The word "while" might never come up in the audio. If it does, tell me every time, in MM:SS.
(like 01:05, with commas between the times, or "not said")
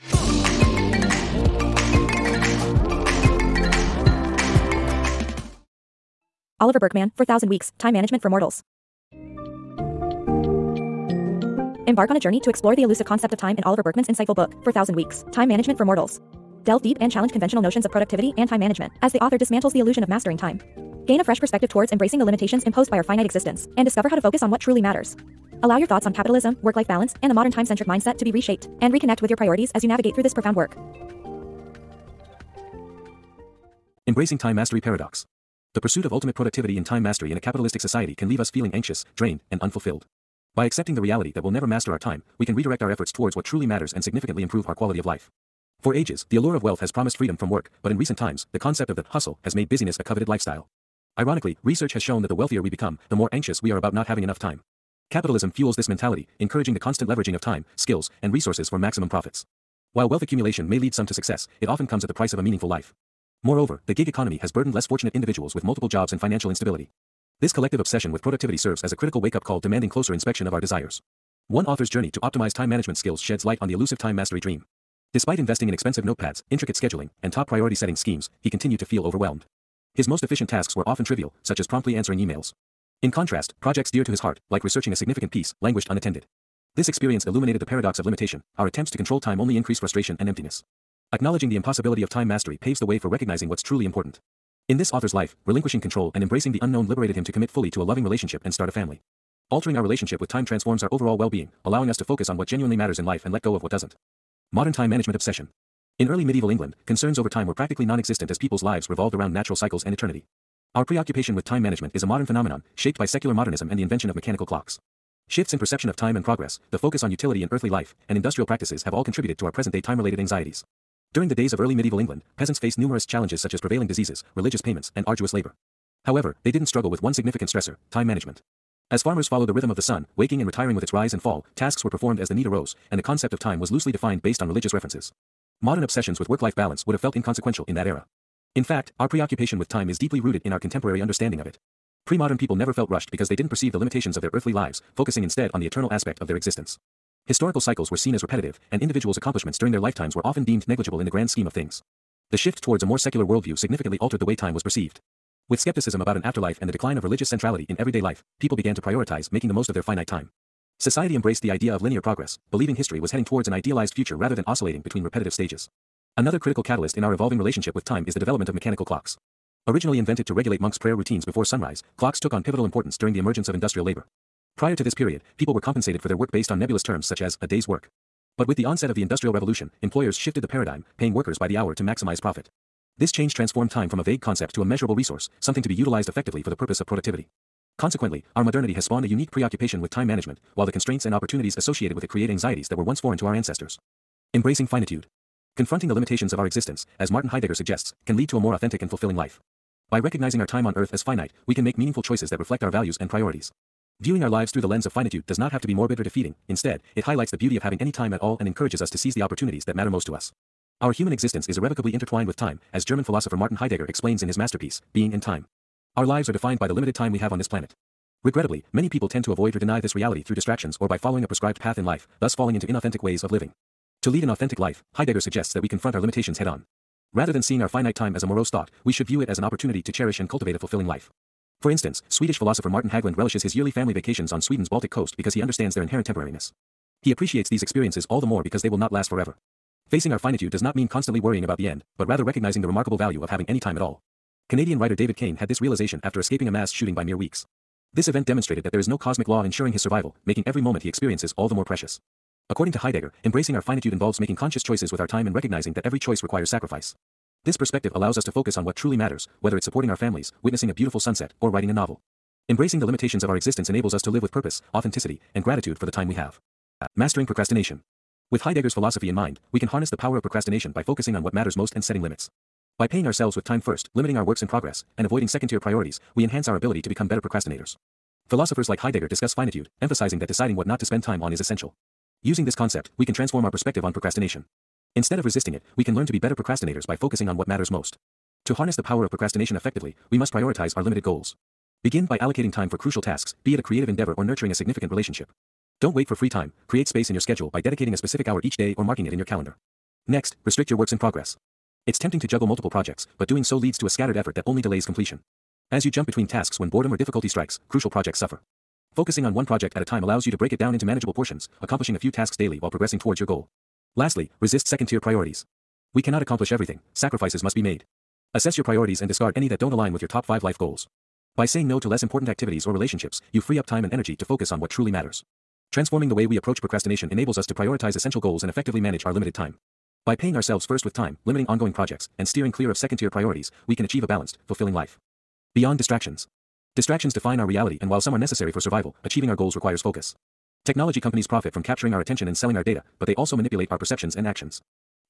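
00:59, 03:10, 05:12, 05:37.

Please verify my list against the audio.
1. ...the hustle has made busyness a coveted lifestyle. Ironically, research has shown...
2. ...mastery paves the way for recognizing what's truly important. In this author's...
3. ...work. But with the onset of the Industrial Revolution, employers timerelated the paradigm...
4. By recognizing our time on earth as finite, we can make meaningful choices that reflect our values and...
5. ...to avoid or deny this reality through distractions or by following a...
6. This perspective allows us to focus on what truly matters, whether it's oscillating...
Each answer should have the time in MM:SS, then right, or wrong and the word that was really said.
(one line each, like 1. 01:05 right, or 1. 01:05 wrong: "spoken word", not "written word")
1. 00:48 right
2. 01:32 right
3. 02:57 wrong: "shifted", not "timerelated"
4. 03:19 right
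5. 03:39 right
6. 04:17 wrong: "supporting", not "oscillating".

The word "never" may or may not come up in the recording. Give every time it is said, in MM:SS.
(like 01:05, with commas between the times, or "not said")
00:41, 02:22.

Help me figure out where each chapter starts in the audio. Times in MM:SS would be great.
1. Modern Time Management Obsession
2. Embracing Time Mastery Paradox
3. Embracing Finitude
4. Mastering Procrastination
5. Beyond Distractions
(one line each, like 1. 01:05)
1. 01:44
2. 00:34
3. 03:14
4. 04:27
5. 05:35.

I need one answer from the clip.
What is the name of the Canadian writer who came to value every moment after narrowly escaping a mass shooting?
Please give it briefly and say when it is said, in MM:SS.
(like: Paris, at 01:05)
David Cain, at 04:04.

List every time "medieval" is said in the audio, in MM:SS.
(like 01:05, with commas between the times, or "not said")
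01:46, 02:01.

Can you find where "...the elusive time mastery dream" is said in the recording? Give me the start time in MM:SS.
01:13.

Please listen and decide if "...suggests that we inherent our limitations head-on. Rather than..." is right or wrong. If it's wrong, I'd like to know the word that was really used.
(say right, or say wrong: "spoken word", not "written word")
wrong: "confront", not "inherent".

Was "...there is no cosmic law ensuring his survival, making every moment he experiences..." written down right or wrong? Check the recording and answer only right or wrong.
right.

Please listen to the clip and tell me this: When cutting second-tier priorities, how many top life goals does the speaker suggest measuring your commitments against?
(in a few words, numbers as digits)
5.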